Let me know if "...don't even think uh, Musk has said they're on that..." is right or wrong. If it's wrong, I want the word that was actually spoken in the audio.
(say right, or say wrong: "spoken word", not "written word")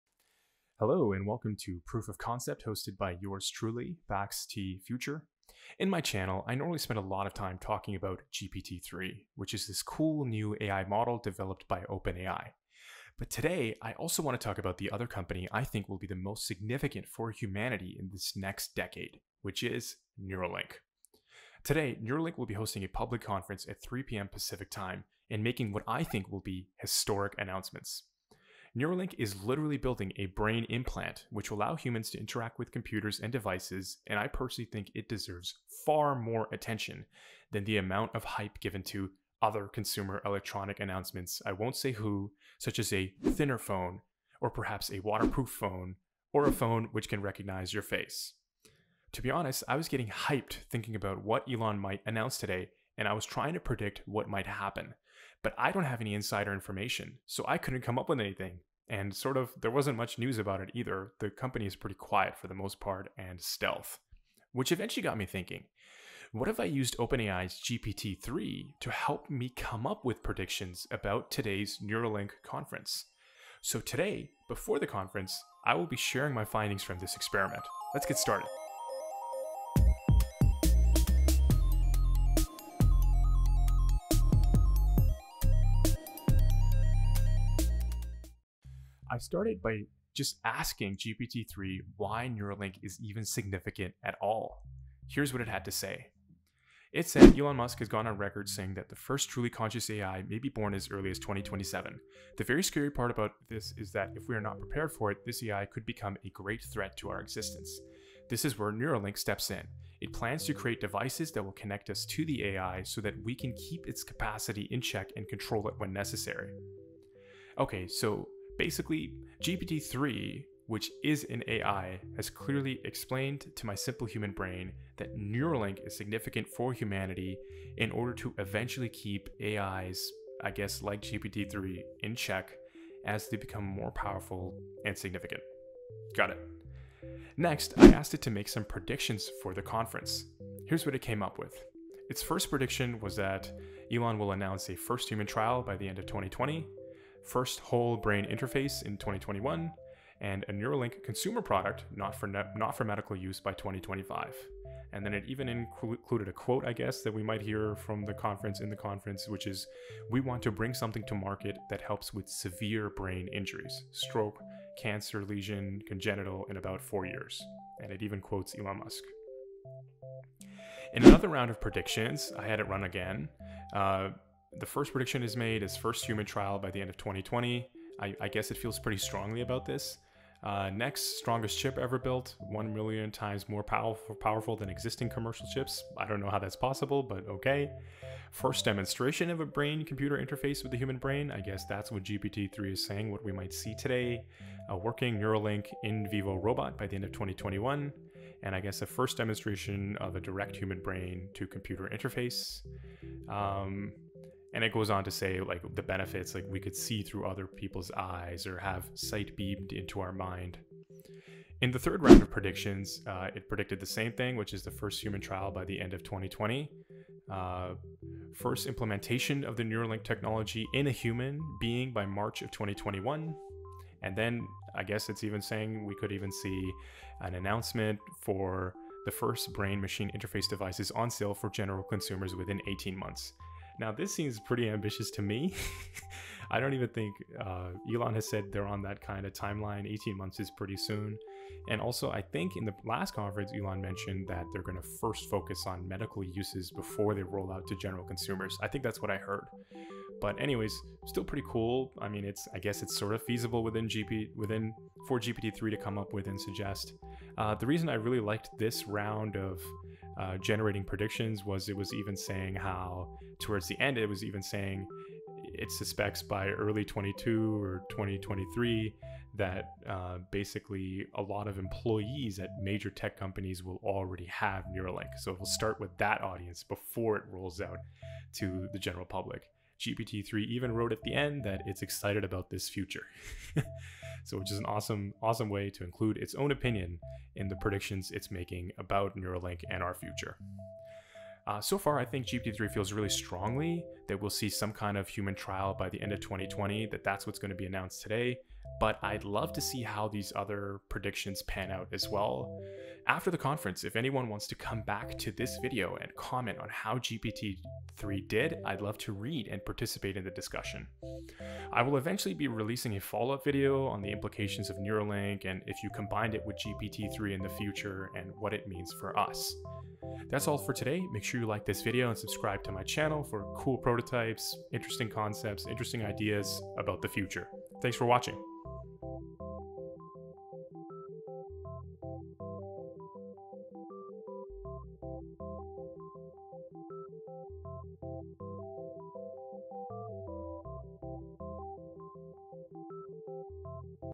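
wrong: "Elon", not "Musk".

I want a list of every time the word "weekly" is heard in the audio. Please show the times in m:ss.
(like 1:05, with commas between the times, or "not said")
not said.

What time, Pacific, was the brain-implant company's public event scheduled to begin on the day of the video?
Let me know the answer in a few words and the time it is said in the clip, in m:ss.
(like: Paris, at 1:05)
3 p.m., at 0:23.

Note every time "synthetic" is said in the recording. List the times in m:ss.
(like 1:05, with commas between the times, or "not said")
not said.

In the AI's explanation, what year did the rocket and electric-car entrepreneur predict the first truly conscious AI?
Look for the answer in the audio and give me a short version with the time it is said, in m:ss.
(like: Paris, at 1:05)
2027, at 1:41.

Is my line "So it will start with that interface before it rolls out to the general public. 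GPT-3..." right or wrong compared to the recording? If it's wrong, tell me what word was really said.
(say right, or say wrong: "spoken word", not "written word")
wrong: "audience", not "interface".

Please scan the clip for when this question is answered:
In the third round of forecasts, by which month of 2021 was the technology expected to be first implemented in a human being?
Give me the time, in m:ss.
3:42.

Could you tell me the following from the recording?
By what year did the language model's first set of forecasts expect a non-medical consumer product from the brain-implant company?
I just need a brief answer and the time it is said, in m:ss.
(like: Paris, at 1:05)
2025, at 2:33.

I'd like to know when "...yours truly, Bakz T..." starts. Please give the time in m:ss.
0:03.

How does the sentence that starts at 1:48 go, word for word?
This is where Neuralink steps in.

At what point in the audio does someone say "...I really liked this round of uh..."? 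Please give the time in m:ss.
4:17.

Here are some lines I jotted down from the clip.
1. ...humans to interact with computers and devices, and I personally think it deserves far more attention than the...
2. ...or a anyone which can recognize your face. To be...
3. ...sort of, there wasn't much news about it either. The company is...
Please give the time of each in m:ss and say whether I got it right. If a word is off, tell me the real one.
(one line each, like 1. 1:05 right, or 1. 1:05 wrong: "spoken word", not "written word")
1. 0:31 right
2. 0:46 wrong: "phone", not "anyone"
3. 0:59 right.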